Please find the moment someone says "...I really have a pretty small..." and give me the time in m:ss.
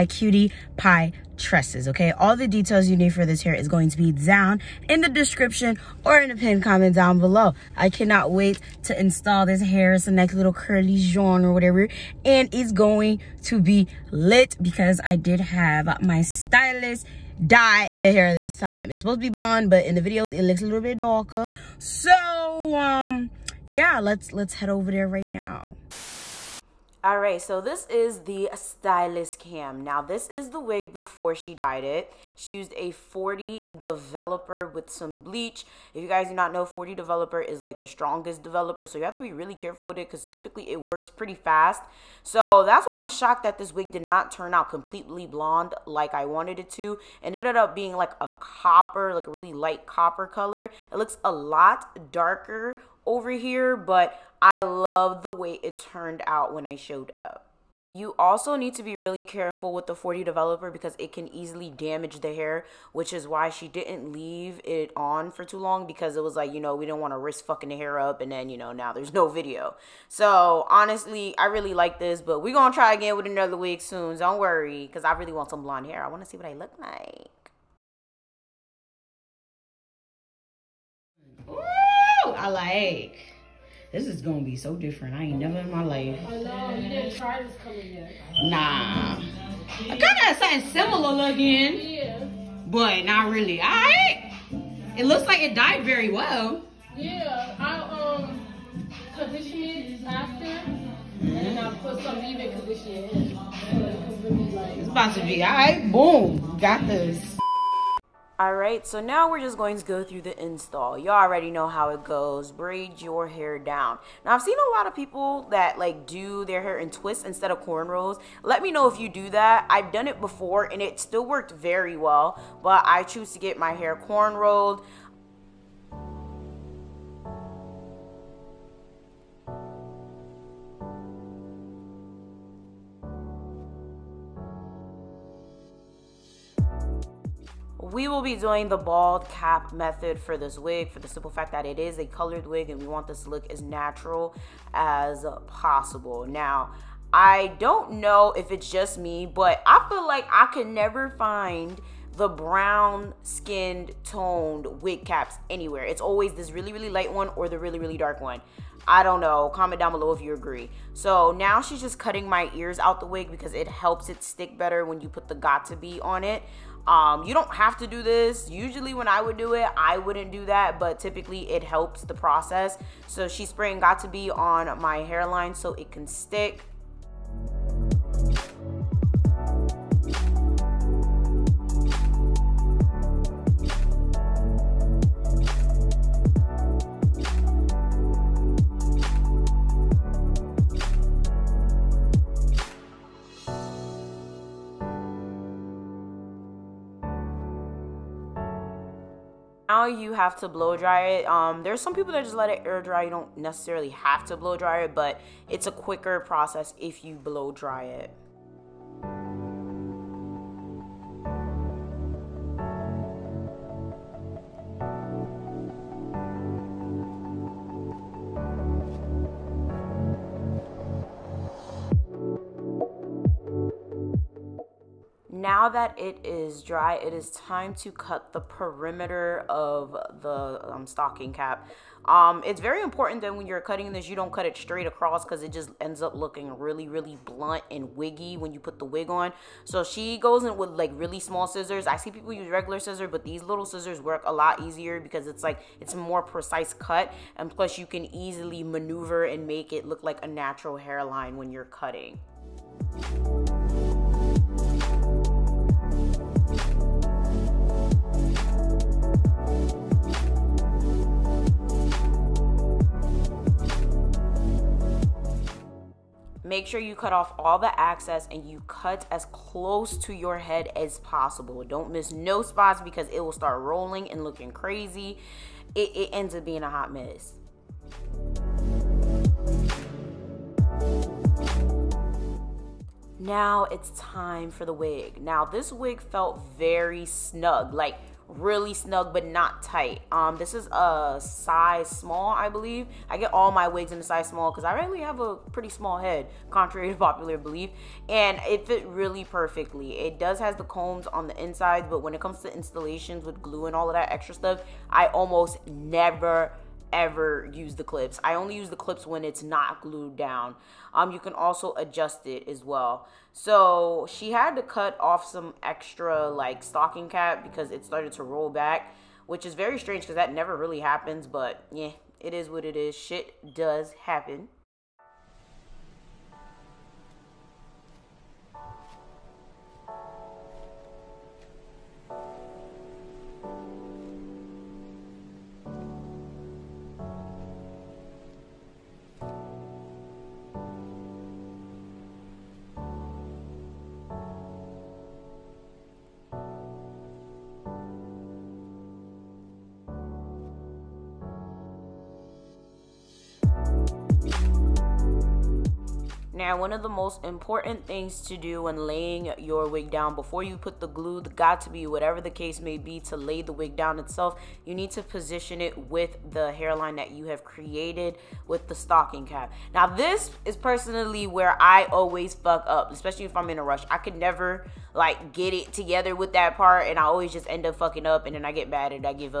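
4:54.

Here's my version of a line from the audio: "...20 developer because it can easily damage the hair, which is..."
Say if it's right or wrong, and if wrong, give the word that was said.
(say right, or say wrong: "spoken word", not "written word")
wrong: "40", not "20".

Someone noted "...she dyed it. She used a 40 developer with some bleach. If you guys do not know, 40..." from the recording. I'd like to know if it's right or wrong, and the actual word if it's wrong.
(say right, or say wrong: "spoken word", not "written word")
right.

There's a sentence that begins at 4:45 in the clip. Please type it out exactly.
Now this wig felt very snug, like really snug but not tight.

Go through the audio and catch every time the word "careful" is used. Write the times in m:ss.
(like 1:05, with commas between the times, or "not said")
0:39, 0:59.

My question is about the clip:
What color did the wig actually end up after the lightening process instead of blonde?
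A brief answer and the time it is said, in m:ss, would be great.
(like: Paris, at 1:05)
light copper, at 0:49.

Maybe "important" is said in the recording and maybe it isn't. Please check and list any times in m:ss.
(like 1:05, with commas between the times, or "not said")
3:52, 5:57.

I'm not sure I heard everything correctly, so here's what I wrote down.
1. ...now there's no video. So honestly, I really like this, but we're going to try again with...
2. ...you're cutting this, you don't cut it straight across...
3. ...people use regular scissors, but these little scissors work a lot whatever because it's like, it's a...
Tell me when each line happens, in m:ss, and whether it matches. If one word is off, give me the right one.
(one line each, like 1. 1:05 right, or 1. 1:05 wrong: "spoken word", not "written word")
1. 1:08 right
2. 3:53 right
3. 4:02 wrong: "easier", not "whatever".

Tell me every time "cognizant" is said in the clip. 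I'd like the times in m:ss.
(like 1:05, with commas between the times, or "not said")
not said.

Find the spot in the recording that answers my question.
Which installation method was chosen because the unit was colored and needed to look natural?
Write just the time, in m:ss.
2:18.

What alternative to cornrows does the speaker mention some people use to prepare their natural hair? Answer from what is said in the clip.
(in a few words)
twists.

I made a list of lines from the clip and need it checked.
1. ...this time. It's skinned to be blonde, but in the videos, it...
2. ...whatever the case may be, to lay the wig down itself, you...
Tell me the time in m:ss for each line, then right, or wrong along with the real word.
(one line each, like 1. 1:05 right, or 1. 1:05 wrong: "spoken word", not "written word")
1. 0:18 wrong: "supposed", not "skinned"
2. 6:01 right.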